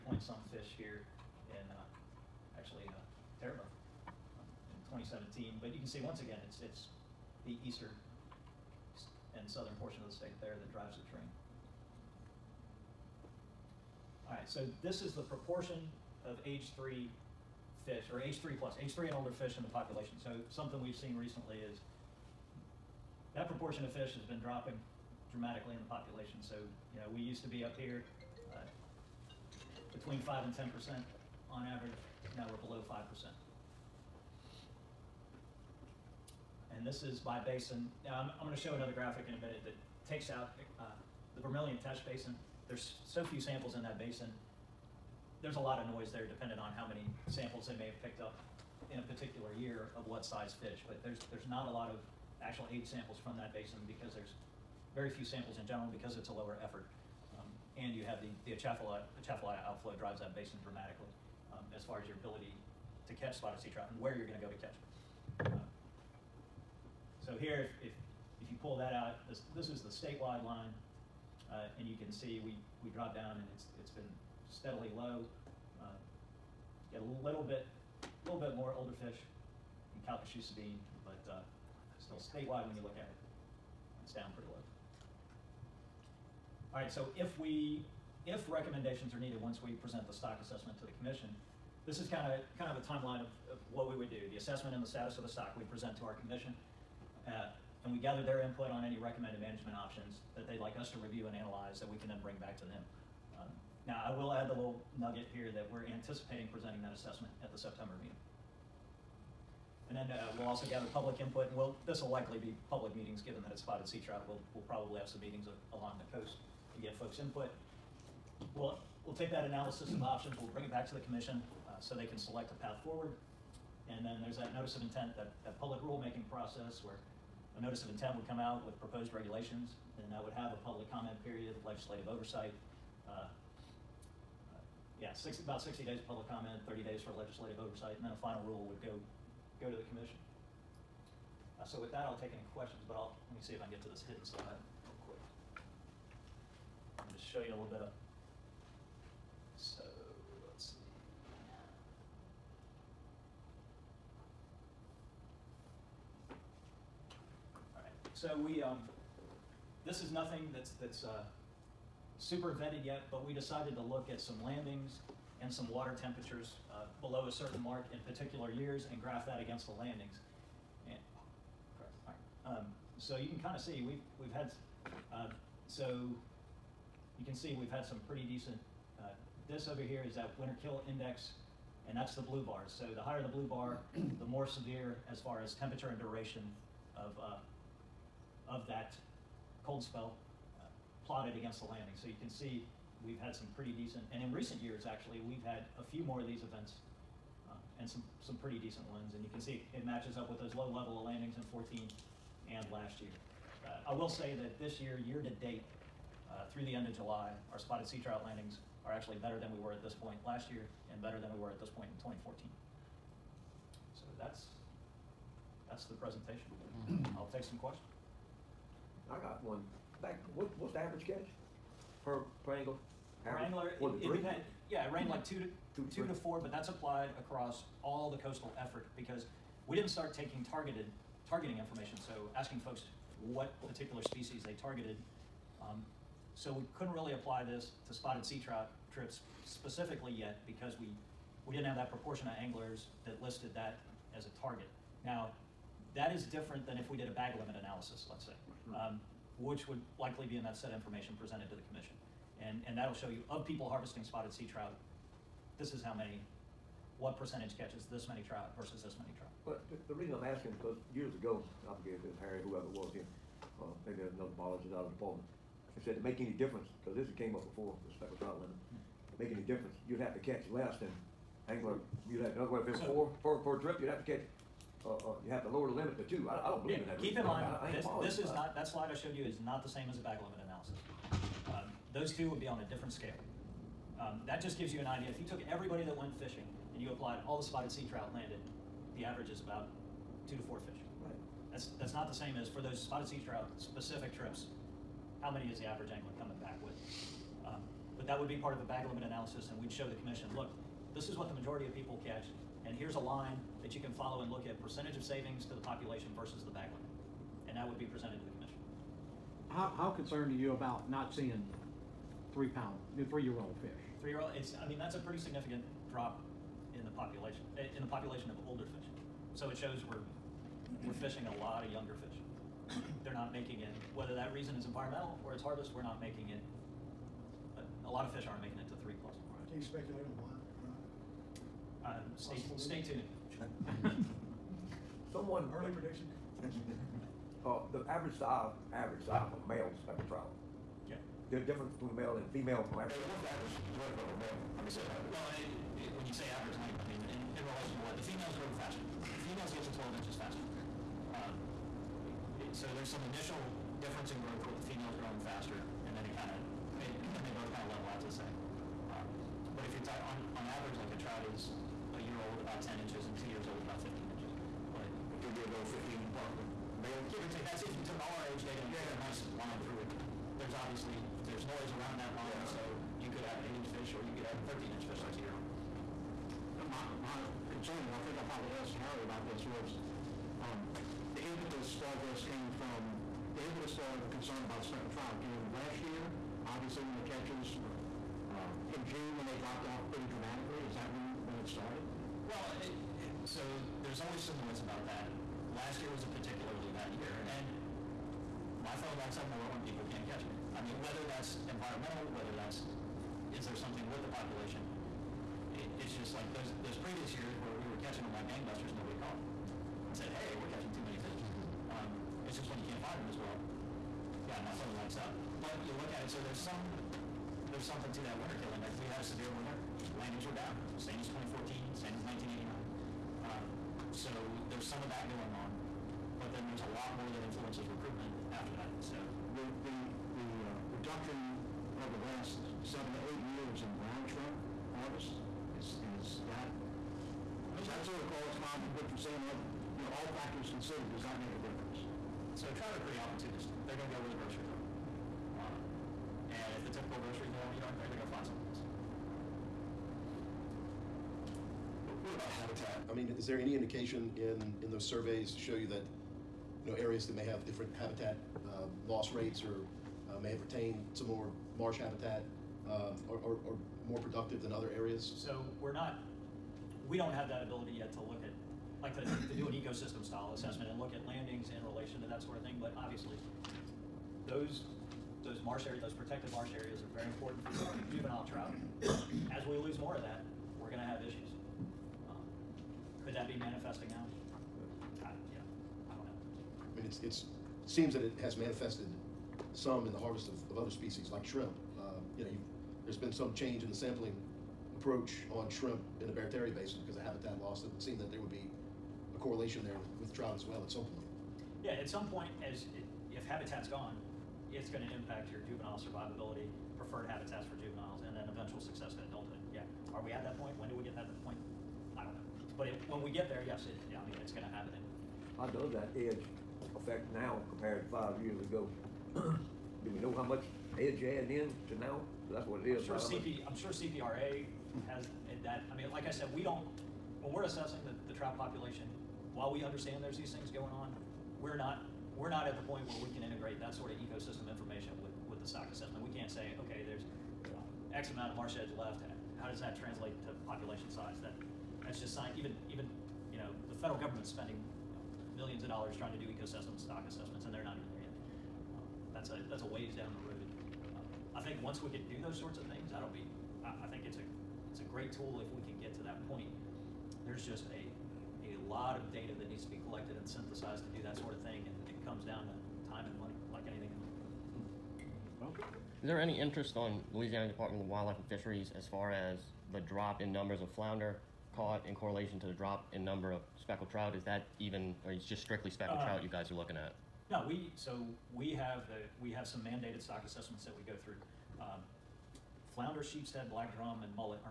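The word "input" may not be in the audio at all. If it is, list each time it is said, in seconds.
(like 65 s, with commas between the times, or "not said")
98 s, 111 s, 117 s.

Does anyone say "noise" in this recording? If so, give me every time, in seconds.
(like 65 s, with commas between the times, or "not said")
45 s, 371 s, 394 s.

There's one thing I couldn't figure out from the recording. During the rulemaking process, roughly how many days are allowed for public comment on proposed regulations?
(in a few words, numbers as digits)
60 days.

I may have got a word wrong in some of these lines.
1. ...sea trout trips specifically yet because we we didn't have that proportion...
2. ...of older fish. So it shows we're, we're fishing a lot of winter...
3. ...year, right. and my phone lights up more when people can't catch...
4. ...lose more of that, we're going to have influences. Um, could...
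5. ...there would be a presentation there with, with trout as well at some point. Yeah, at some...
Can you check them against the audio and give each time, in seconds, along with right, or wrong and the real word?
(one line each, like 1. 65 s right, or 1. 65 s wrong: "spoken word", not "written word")
1. 238 s right
2. 318 s wrong: "younger", not "winter"
3. 396 s right
4. 479 s wrong: "issues", not "influences"
5. 498 s wrong: "correlation", not "presentation".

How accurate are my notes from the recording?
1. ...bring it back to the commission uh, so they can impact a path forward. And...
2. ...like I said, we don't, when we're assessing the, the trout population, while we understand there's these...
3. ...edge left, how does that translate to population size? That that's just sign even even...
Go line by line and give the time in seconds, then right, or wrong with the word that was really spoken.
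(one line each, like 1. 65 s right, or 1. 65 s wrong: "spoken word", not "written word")
1. 120 s wrong: "select", not "impact"
2. 525 s right
3. 538 s right.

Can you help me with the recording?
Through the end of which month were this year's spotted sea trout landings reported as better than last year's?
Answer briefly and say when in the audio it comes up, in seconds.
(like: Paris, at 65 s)
July, at 206 s.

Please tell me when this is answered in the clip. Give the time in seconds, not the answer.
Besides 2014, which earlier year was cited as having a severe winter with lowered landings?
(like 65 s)
422 s.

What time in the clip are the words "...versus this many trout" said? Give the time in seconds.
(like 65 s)
258 s.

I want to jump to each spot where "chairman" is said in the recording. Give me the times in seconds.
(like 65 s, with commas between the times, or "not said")
not said.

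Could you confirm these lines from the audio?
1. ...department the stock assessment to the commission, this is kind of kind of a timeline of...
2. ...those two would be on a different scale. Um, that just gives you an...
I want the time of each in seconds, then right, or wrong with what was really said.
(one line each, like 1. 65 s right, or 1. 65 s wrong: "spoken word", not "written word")
1. 89 s wrong: "present", not "department"
2. 281 s right.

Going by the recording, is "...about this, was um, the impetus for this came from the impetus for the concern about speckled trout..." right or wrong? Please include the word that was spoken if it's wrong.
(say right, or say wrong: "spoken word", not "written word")
right.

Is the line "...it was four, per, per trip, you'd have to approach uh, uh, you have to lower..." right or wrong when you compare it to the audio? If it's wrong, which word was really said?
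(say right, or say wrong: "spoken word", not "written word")
wrong: "catch", not "approach".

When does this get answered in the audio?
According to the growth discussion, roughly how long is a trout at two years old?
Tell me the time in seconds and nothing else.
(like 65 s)
363 s.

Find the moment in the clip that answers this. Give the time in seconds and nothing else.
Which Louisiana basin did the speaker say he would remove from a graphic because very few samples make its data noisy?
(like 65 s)
41 s.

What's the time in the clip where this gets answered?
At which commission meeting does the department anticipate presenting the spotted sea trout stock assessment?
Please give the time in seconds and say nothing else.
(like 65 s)
107 s.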